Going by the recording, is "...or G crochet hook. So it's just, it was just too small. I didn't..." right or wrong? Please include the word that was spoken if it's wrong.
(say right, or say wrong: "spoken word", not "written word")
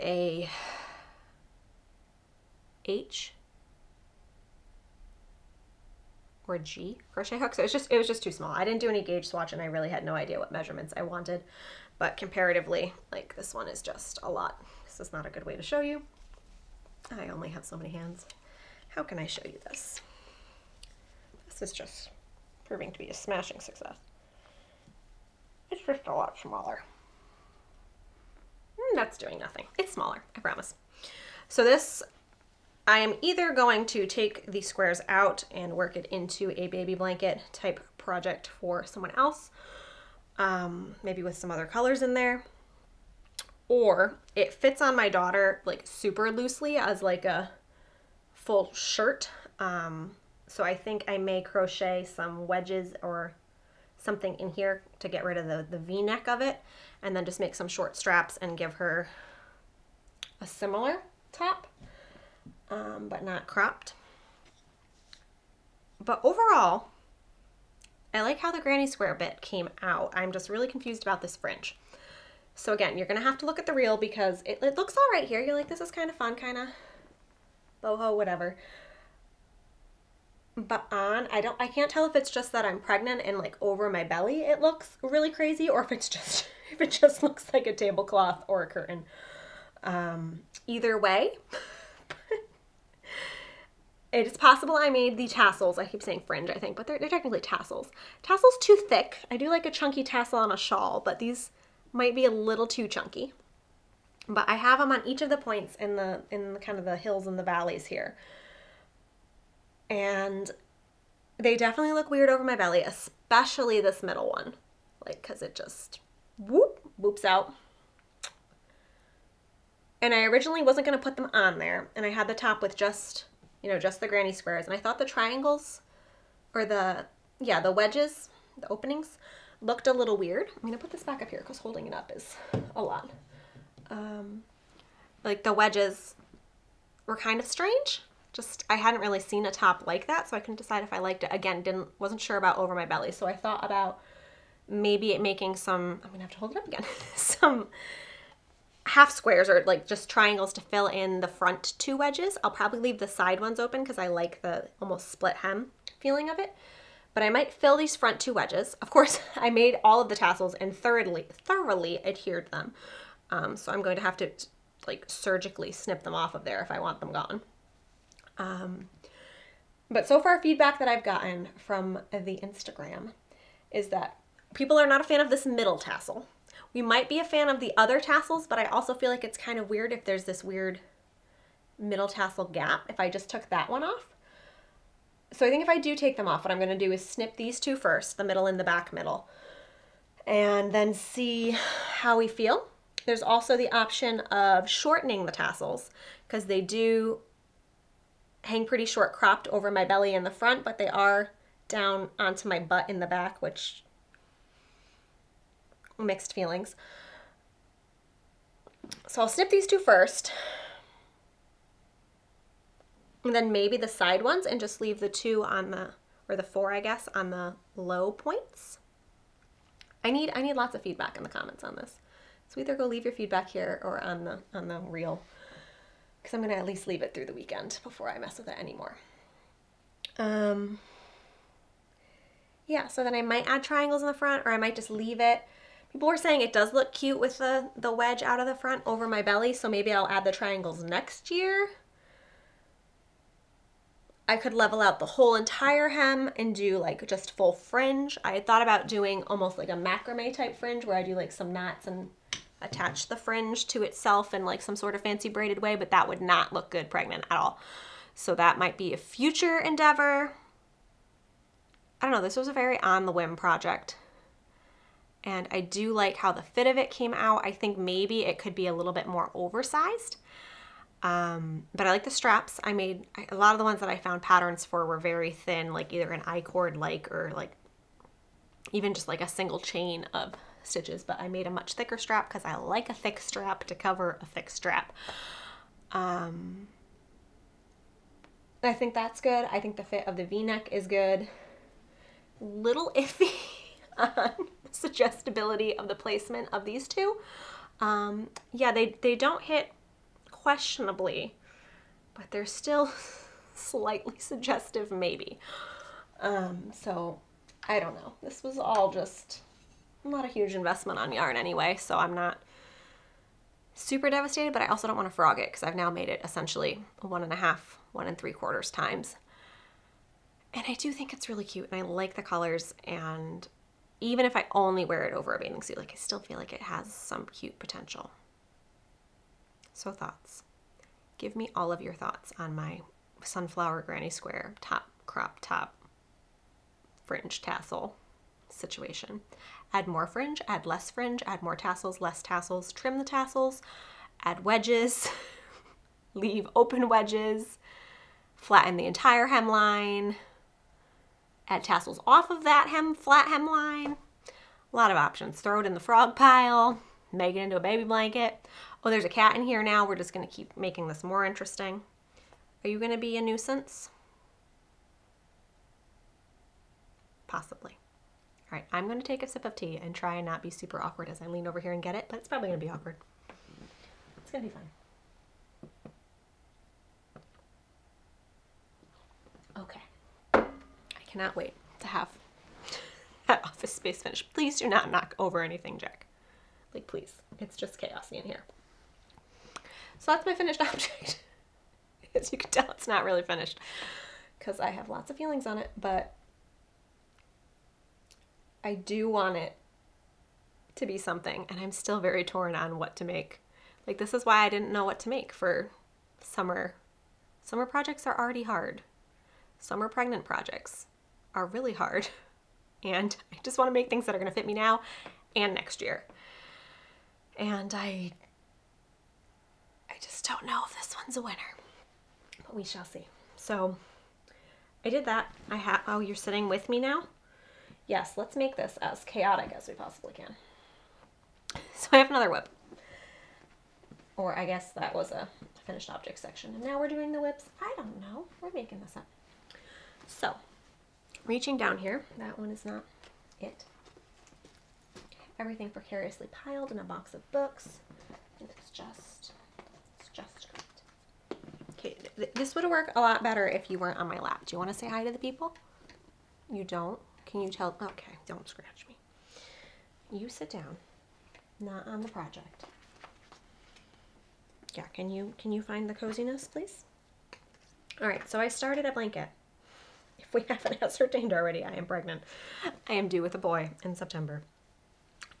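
right.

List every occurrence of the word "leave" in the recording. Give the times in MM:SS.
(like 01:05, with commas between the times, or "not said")
02:32, 03:34, 03:42, 03:46, 03:54, 05:46.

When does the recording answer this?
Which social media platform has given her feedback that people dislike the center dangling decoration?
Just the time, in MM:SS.
02:52.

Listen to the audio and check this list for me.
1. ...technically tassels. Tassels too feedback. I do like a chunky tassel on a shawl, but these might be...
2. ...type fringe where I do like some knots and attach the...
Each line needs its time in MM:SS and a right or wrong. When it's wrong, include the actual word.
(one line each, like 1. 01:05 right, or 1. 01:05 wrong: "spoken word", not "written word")
1. 01:37 wrong: "thick", not "feedback"
2. 04:10 right.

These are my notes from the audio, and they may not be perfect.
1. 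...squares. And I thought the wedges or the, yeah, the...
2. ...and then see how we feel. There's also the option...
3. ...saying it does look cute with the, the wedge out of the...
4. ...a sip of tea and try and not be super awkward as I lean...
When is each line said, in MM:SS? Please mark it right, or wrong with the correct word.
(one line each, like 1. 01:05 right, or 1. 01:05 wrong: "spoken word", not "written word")
1. 02:04 wrong: "triangles", not "wedges"
2. 03:10 right
3. 03:56 right
4. 06:09 right.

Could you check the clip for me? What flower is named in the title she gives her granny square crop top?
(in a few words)
Sunflower.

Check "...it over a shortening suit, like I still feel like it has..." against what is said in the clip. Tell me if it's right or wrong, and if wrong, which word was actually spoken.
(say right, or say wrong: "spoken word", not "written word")
wrong: "bathing", not "shortening".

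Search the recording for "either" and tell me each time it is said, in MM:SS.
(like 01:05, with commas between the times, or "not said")
00:33, 01:30, 03:42, 04:35.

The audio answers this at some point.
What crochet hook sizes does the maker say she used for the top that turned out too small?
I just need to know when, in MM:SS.
00:02.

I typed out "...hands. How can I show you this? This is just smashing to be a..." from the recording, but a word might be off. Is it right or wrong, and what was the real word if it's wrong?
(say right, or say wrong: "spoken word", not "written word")
wrong: "proving", not "smashing".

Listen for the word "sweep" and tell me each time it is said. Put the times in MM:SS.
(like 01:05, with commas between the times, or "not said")
not said.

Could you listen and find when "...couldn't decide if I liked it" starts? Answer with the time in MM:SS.
02:20.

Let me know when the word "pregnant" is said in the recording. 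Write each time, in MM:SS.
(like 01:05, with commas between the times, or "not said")
01:22, 04:16, 06:49, 07:51.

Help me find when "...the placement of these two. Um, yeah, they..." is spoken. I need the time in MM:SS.
04:55.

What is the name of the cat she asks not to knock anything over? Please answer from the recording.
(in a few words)
Jack.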